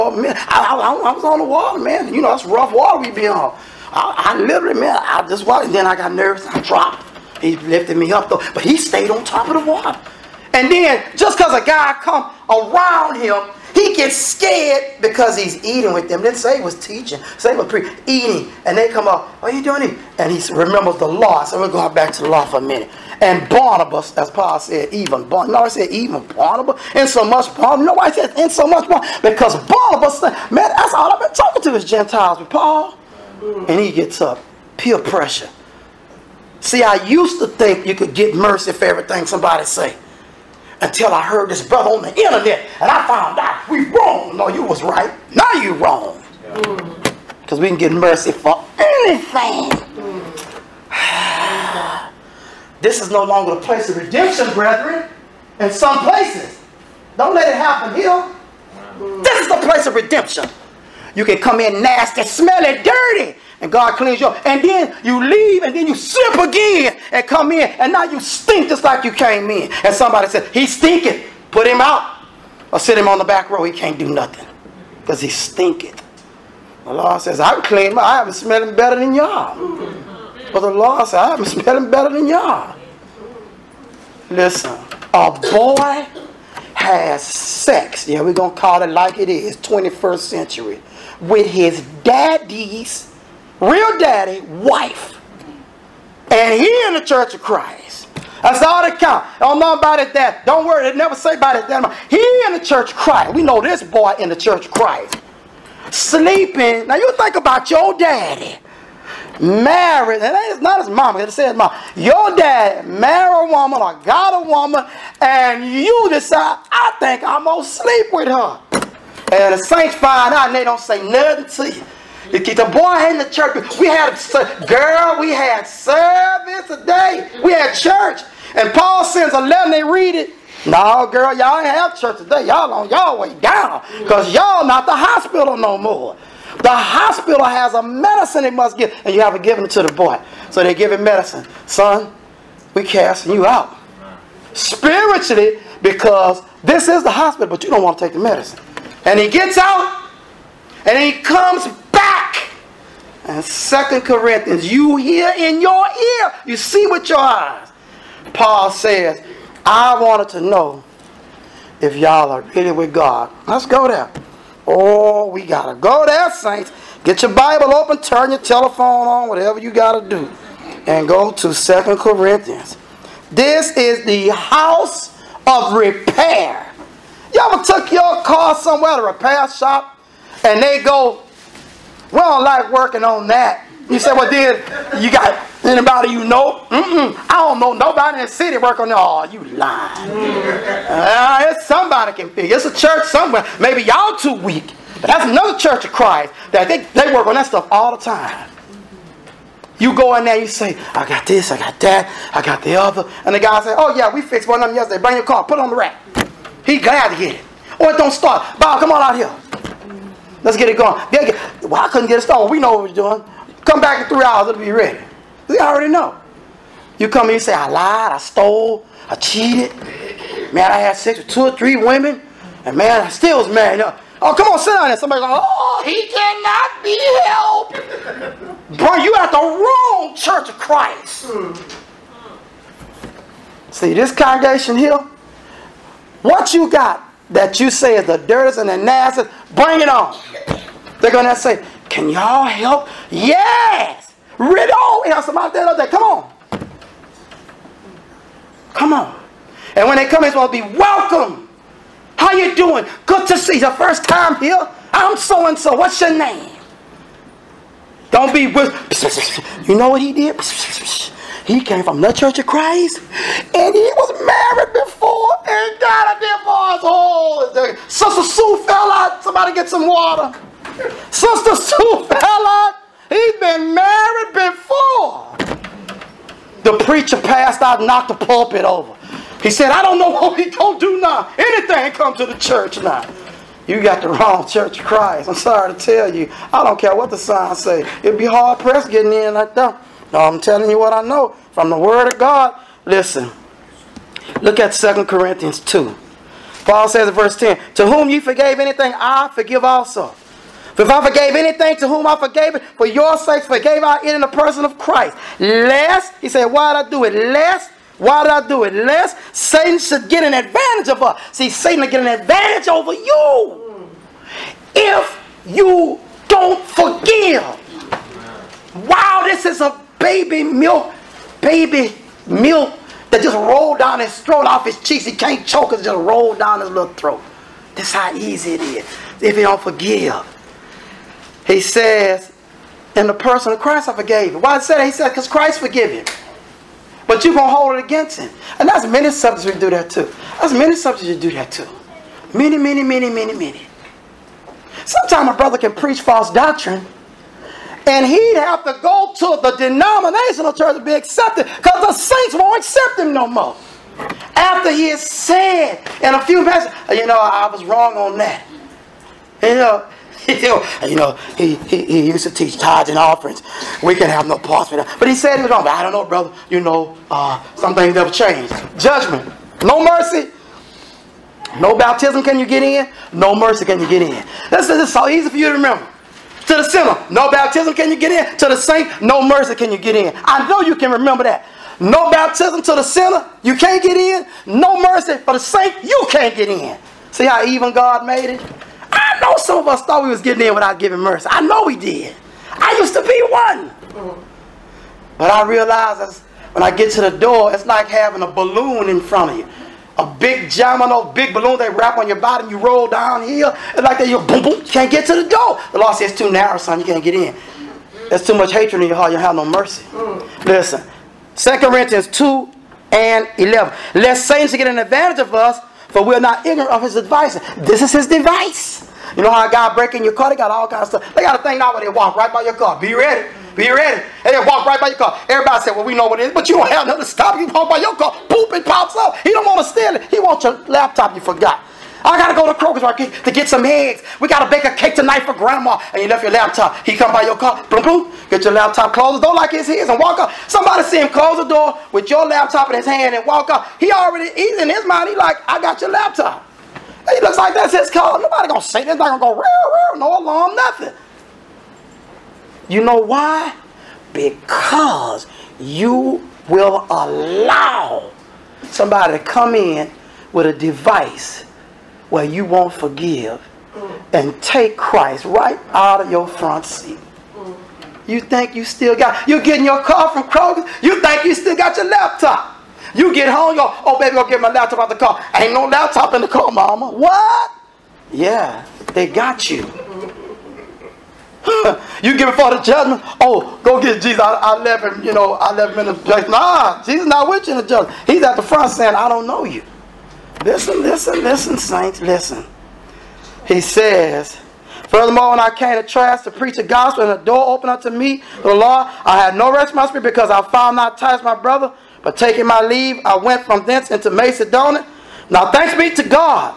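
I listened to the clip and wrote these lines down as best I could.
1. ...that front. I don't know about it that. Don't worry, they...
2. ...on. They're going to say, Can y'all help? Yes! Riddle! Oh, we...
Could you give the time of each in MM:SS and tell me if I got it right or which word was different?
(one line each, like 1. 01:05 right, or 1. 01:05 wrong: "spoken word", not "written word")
1. 01:38 wrong: "count", not "front"
2. 03:59 right.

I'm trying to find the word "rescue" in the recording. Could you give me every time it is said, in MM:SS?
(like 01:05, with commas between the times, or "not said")
not said.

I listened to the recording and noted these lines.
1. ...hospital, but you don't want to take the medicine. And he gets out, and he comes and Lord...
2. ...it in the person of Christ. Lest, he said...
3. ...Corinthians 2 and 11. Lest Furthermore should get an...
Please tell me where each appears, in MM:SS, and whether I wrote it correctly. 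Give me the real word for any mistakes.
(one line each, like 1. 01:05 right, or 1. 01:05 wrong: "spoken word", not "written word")
1. 02:27 wrong: "Second", not "Lord"
2. 05:04 right
3. 06:51 wrong: "Satan", not "Furthermore".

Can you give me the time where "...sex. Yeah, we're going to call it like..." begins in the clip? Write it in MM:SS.
01:27.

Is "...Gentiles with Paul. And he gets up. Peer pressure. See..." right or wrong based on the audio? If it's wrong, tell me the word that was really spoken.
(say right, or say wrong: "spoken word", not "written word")
right.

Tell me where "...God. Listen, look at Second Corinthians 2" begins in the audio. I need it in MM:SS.
04:52.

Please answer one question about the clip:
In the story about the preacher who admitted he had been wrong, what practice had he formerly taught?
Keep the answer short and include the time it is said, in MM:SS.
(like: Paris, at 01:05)
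Tithes and offerings, at 06:02.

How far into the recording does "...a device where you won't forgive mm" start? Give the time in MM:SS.
07:40.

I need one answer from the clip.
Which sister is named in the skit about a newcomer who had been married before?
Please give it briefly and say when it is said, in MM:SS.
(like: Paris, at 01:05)
Sister Sue Ballard, at 04:31.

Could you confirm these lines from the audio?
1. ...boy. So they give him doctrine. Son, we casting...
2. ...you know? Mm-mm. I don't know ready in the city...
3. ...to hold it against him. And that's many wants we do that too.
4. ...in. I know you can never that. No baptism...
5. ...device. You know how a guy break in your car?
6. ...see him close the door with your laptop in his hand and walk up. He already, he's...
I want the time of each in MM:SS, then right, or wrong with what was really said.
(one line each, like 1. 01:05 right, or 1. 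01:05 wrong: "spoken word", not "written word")
1. 02:19 wrong: "medicine", not "doctrine"
2. 03:06 wrong: "nobody", not "ready"
3. 05:37 wrong: "subjects", not "wants"
4. 06:19 wrong: "remember", not "never"
5. 06:58 right
6. 07:20 right.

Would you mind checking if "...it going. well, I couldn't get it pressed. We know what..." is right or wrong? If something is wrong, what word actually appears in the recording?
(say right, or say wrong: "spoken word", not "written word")
wrong: "started", not "pressed".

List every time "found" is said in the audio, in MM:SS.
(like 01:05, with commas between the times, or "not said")
00:43, 08:20.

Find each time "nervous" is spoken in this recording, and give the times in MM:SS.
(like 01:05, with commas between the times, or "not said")
00:06.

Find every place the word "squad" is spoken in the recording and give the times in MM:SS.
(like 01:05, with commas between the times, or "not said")
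not said.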